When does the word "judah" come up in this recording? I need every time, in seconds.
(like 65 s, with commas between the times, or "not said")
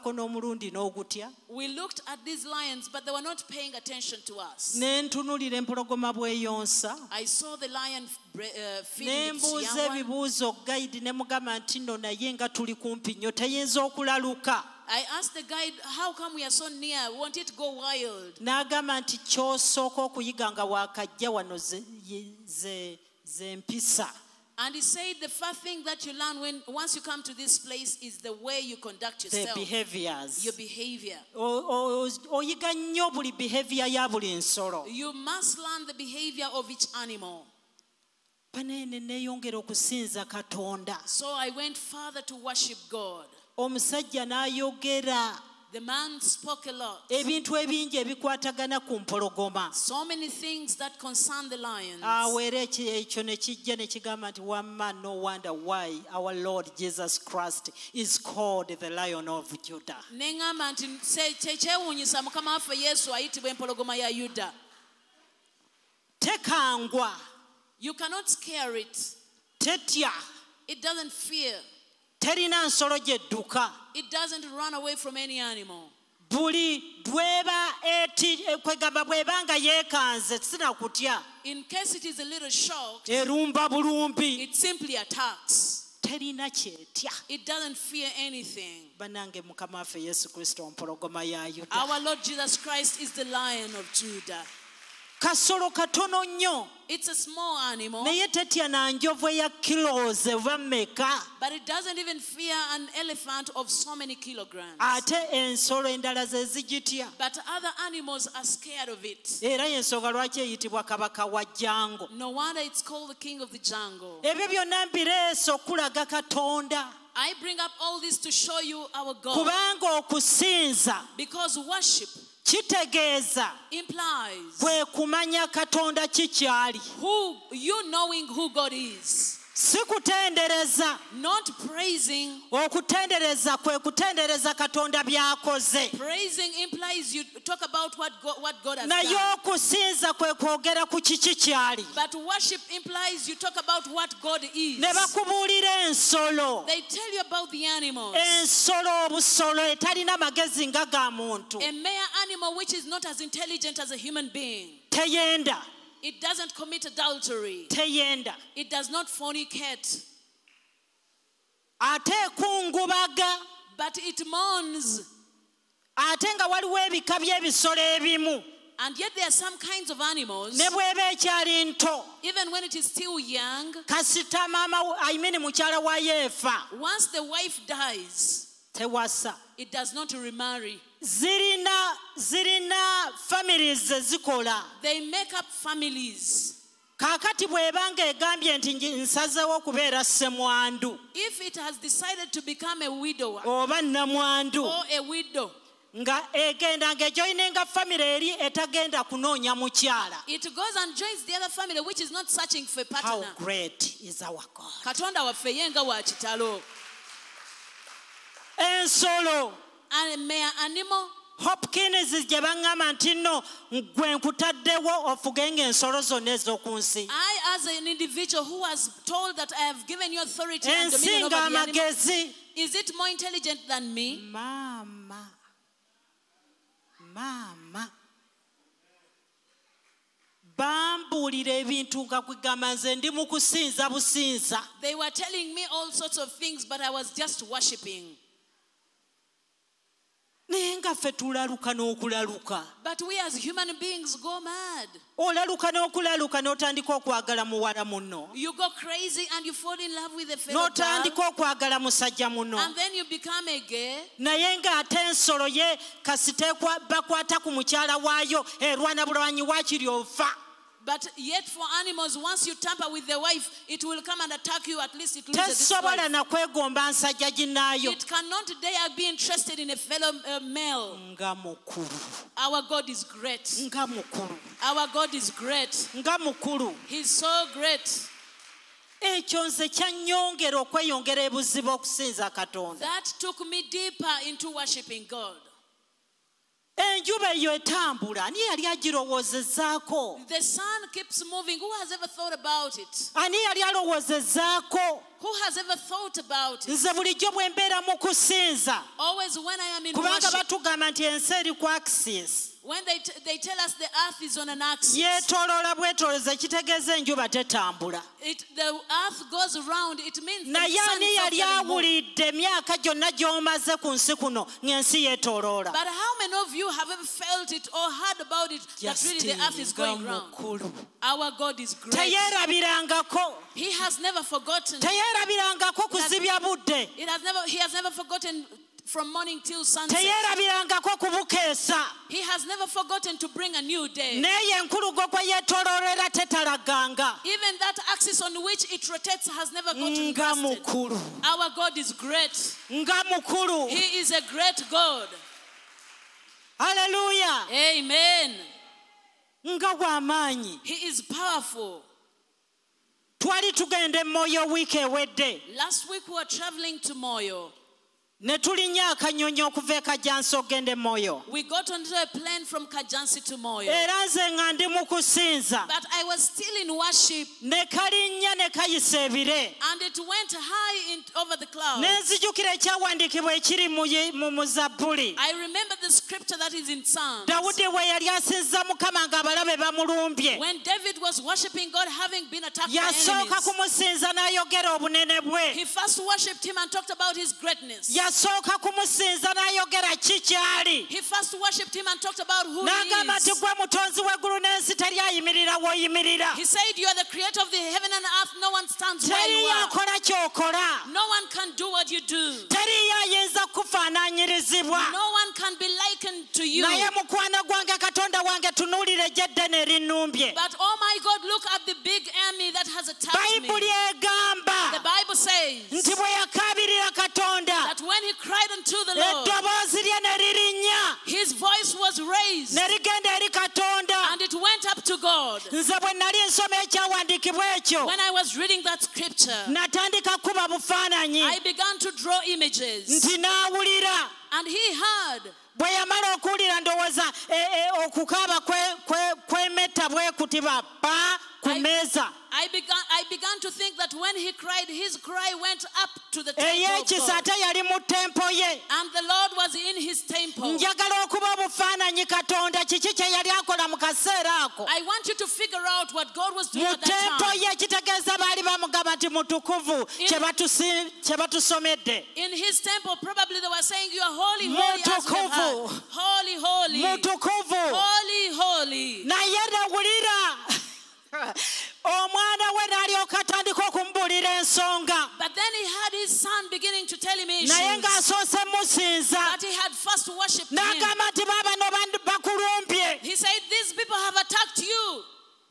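59 s, 93 s.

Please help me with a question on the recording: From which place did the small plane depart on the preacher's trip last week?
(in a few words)
Kajansi.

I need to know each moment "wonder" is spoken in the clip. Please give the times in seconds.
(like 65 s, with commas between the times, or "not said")
55 s, 112 s.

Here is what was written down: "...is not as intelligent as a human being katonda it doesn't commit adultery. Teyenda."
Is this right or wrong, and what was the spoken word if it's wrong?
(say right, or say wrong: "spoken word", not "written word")
wrong: "teyenda", not "katonda".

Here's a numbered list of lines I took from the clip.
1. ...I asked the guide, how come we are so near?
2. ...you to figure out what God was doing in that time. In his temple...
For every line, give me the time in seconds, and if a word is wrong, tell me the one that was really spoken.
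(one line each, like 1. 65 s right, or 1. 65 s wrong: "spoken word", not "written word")
1. 14 s right
2. 455 s right.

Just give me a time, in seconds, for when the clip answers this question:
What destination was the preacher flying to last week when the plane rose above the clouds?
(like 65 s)
356 s.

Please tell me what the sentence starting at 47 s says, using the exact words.
ebintu ebingi ebikwatagana ku mpologoma the lion.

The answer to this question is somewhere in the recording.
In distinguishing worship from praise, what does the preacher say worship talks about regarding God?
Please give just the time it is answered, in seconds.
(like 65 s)
143 s.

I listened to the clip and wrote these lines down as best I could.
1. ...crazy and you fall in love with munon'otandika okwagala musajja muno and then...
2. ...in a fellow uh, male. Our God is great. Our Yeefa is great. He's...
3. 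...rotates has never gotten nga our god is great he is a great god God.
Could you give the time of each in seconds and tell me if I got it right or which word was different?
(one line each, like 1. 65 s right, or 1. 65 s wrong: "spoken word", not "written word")
1. 248 s right
2. 269 s wrong: "God", not "Yeefa"
3. 338 s wrong: "Hallelujah", not "God".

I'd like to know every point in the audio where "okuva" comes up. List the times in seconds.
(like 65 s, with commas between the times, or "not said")
359 s.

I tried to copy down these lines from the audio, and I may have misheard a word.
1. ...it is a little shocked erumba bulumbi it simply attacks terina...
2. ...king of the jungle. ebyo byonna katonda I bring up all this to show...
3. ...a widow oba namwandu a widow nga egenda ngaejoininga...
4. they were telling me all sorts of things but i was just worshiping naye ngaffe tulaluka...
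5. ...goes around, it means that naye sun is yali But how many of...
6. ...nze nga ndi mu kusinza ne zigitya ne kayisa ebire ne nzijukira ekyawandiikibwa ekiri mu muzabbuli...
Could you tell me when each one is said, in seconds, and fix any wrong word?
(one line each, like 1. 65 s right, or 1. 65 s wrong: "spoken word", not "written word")
1. 81 s right
2. 113 s right
3. 192 s right
4. 230 s right
5. 309 s right
6. 364 s wrong: "kalinnya", not "zigitya".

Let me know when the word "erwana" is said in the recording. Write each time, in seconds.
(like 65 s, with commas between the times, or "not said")
258 s.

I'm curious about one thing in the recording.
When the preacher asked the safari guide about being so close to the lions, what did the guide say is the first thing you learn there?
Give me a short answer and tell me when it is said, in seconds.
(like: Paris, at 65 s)
the way you conduct yourself, at 28 s.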